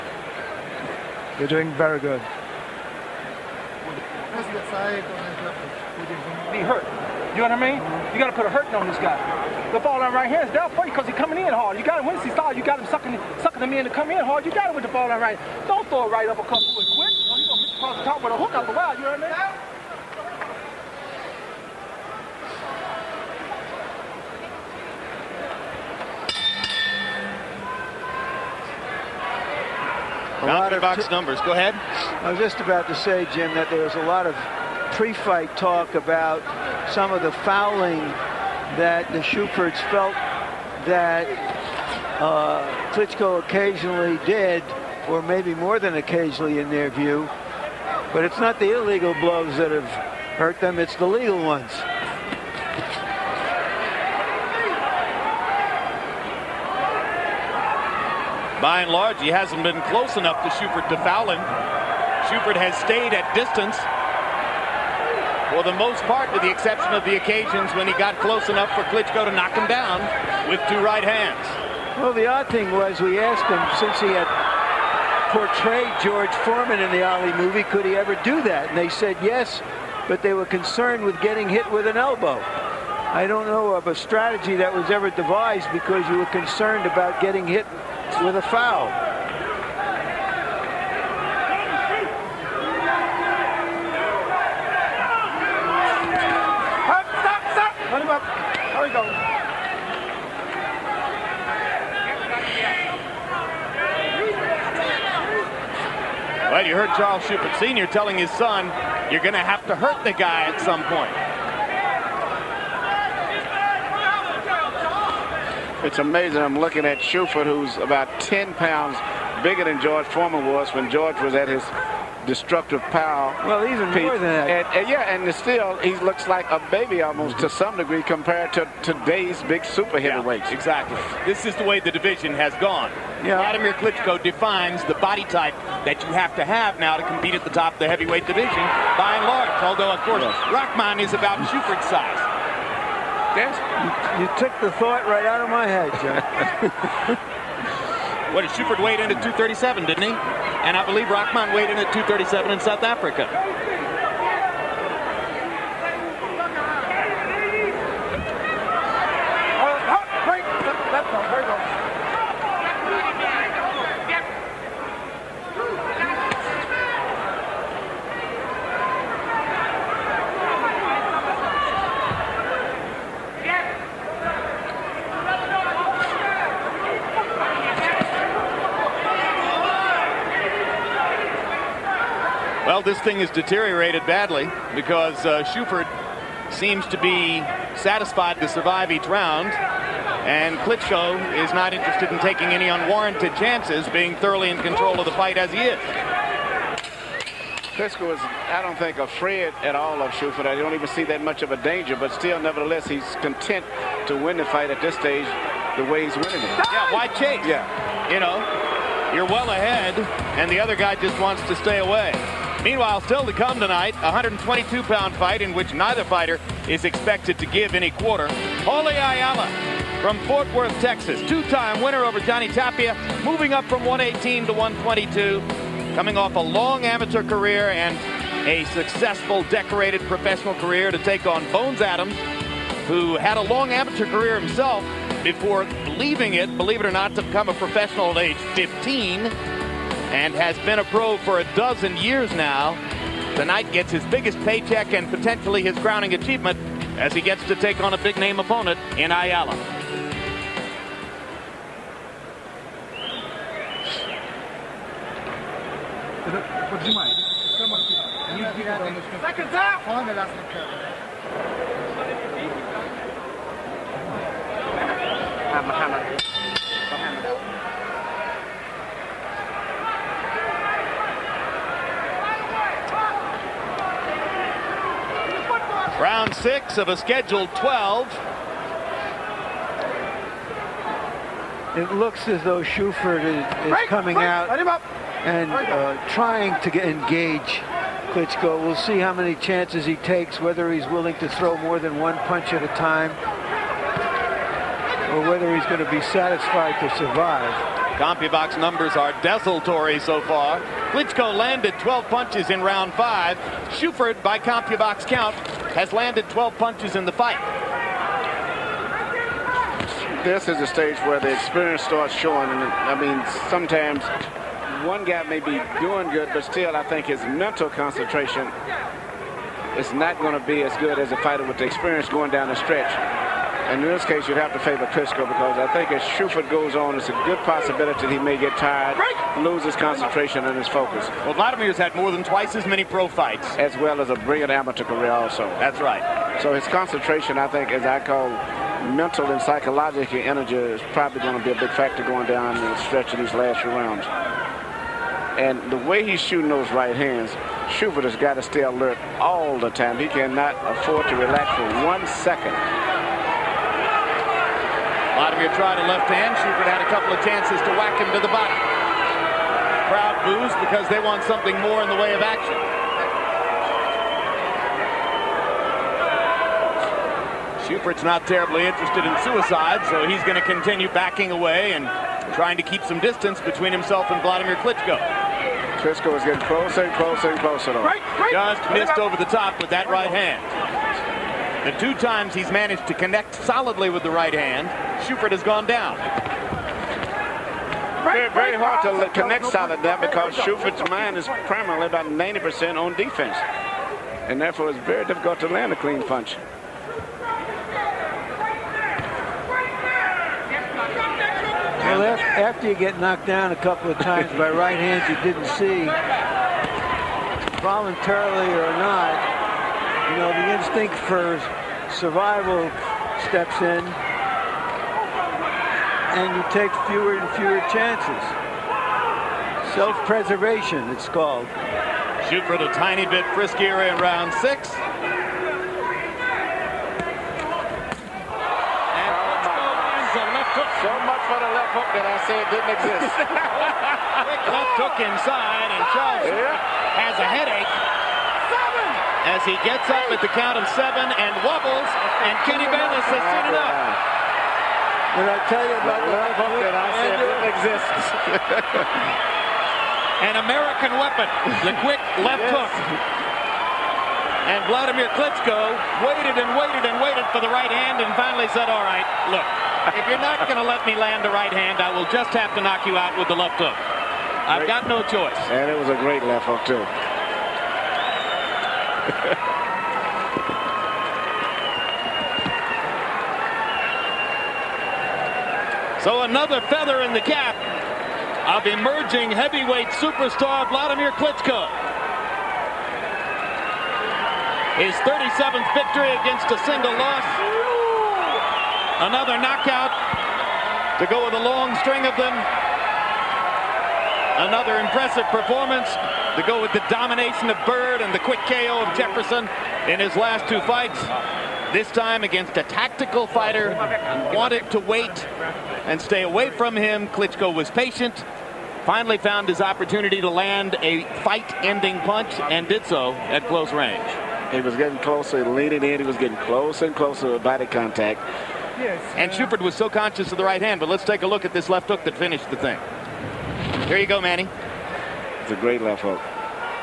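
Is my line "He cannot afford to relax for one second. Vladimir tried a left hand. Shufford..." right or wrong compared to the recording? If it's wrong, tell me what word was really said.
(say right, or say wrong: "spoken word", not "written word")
right.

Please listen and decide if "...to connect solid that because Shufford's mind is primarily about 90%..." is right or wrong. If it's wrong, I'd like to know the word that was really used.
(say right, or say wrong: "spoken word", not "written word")
right.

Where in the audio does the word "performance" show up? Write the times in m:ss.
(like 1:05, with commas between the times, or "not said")
8:15.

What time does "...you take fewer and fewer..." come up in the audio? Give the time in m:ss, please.
6:56.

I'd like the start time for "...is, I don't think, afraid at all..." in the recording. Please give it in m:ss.
3:18.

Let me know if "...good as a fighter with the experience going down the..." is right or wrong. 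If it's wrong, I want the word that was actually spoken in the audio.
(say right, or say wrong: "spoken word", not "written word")
right.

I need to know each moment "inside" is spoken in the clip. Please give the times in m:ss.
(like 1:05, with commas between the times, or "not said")
7:15.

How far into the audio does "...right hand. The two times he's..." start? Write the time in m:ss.
6:19.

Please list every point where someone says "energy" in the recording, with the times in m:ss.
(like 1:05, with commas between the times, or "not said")
5:40.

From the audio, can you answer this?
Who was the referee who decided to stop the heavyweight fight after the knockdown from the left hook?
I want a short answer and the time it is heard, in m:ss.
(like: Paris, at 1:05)
Kenny Bayless, at 7:22.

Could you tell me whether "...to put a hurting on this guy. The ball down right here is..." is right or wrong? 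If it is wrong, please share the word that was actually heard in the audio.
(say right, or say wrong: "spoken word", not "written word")
right.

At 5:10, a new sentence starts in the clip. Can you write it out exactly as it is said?
This is a stage where the experience starts showing.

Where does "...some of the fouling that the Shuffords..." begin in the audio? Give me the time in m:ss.
0:36.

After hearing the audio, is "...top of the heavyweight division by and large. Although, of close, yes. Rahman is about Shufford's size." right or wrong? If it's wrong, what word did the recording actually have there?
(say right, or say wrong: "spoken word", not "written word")
wrong: "course", not "close".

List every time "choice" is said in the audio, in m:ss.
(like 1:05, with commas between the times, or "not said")
7:45.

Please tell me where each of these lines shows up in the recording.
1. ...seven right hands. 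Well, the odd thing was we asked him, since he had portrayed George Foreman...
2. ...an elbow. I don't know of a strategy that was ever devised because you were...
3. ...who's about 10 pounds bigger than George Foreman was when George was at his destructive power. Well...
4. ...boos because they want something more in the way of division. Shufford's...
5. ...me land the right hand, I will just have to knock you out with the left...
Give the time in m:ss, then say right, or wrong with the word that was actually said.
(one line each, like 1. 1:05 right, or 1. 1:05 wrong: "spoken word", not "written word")
1. 1:10 wrong: "two", not "seven"
2. 1:21 right
3. 1:57 right
4. 6:00 wrong: "action", not "division"
5. 7:40 right.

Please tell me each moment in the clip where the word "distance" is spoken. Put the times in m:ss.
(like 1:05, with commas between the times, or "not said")
1:03, 6:13.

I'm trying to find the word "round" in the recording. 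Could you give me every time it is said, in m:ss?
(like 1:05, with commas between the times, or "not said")
3:09, 5:02, 5:43, 7:04.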